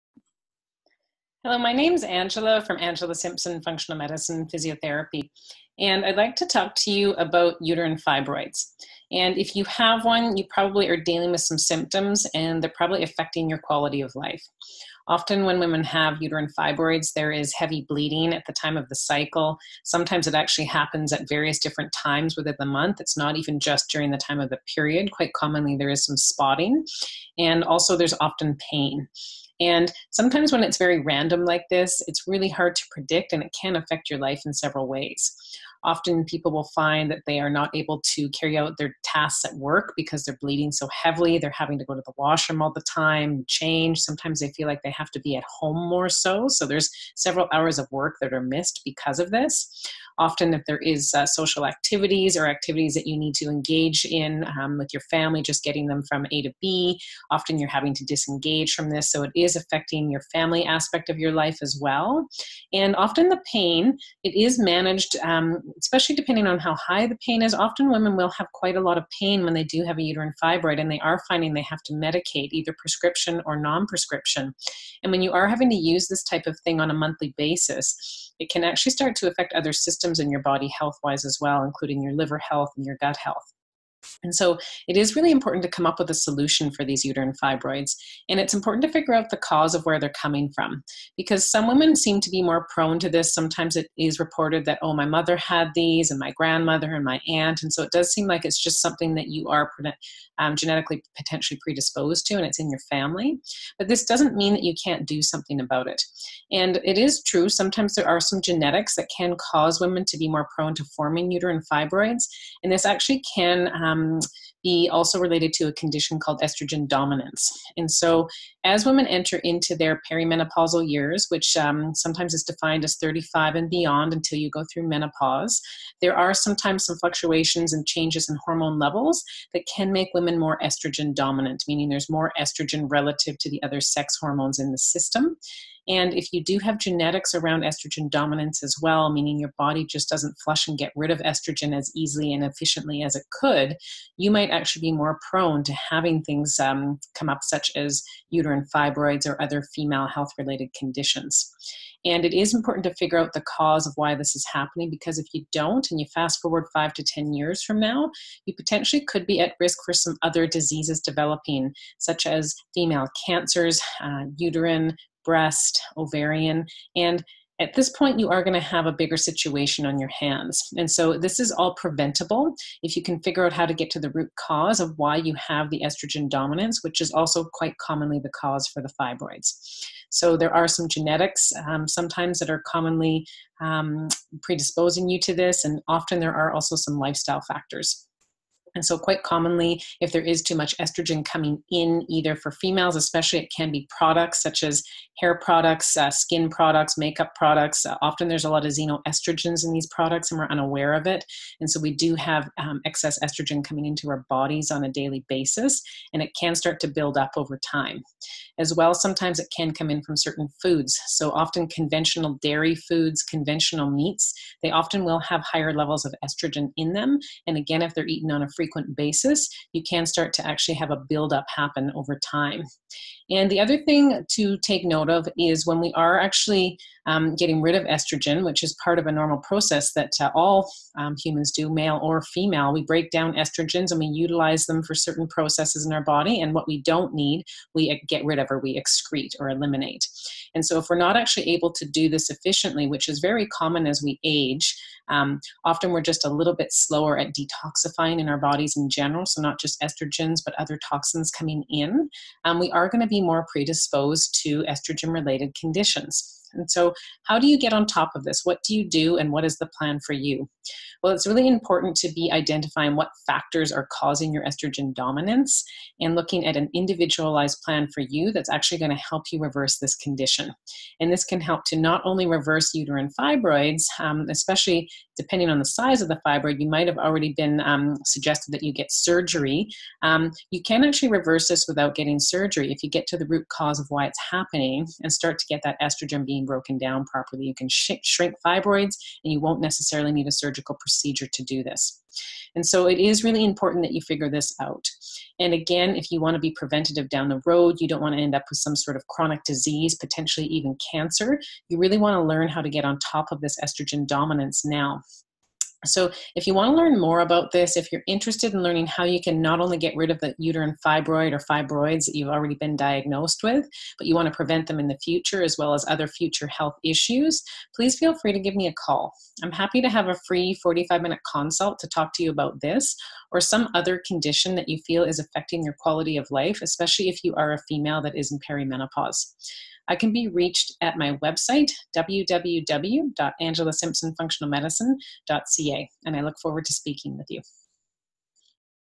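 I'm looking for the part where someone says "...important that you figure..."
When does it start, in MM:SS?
04:53.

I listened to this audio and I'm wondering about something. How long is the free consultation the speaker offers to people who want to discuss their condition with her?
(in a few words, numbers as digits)
45 minutes.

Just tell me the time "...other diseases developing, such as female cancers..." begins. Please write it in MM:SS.
02:40.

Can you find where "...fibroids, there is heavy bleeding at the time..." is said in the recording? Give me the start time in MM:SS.
00:16.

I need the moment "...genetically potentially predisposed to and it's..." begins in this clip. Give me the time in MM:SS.
01:40.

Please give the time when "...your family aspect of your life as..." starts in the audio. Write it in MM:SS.
01:00.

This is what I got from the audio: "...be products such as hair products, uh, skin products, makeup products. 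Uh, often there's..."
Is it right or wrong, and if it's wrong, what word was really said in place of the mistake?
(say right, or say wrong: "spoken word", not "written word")
right.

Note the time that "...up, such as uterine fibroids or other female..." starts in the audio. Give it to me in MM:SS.
02:27.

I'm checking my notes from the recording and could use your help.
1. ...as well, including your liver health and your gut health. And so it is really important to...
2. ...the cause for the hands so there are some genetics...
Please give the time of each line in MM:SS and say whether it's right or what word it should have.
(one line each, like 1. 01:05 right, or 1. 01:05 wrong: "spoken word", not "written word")
1. 01:21 right
2. 02:58 wrong: "fibroids", not "hands".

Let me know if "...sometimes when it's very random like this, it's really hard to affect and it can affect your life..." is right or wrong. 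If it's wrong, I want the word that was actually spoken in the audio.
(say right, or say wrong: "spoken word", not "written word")
wrong: "predict", not "affect".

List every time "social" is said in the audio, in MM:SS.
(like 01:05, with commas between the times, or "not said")
00:51.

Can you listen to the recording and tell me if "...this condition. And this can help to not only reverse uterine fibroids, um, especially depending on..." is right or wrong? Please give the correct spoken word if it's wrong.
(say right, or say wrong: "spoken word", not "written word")
right.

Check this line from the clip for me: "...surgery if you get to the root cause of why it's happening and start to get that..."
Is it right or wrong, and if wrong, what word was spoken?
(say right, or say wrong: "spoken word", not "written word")
right.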